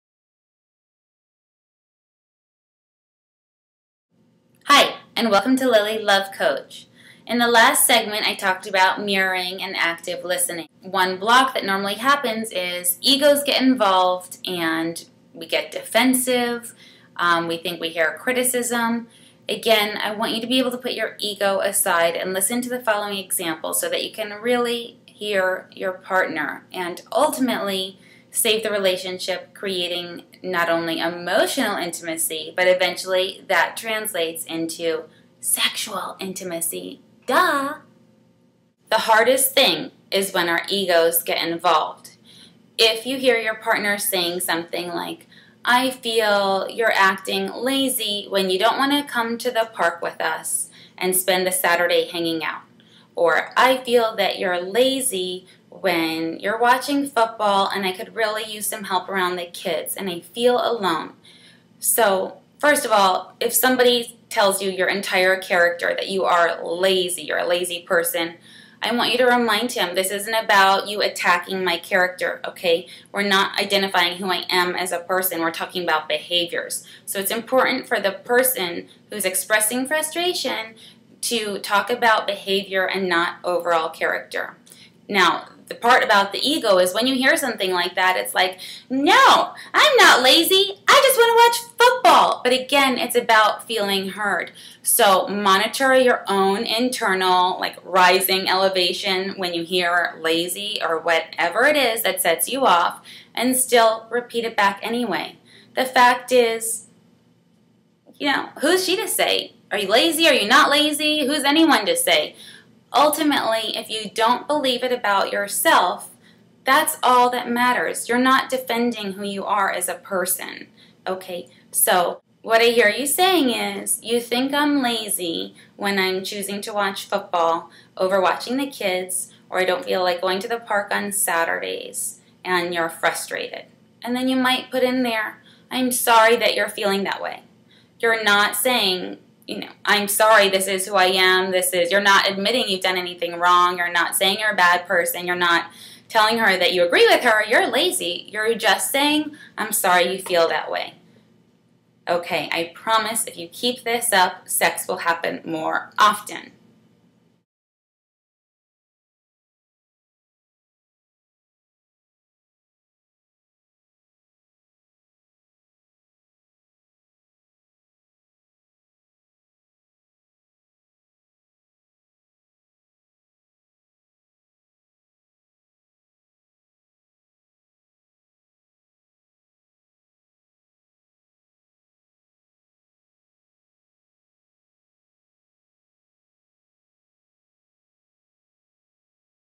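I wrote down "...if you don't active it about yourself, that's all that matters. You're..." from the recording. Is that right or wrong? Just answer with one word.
wrong.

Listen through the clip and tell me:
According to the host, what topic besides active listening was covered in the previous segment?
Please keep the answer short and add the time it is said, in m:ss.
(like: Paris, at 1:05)
Mirroring, at 0:09.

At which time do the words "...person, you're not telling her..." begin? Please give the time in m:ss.
2:24.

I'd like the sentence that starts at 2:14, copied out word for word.
And then you might put in there, I'm sorry that you're feeling that way.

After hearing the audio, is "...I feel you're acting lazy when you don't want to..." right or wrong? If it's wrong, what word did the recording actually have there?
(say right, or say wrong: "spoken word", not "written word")
right.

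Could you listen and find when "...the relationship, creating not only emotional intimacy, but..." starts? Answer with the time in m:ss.
0:28.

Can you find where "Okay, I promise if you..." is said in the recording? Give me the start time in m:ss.
2:32.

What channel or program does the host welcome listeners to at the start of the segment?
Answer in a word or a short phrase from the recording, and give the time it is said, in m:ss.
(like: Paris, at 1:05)
Lily Love Coach, at 0:05.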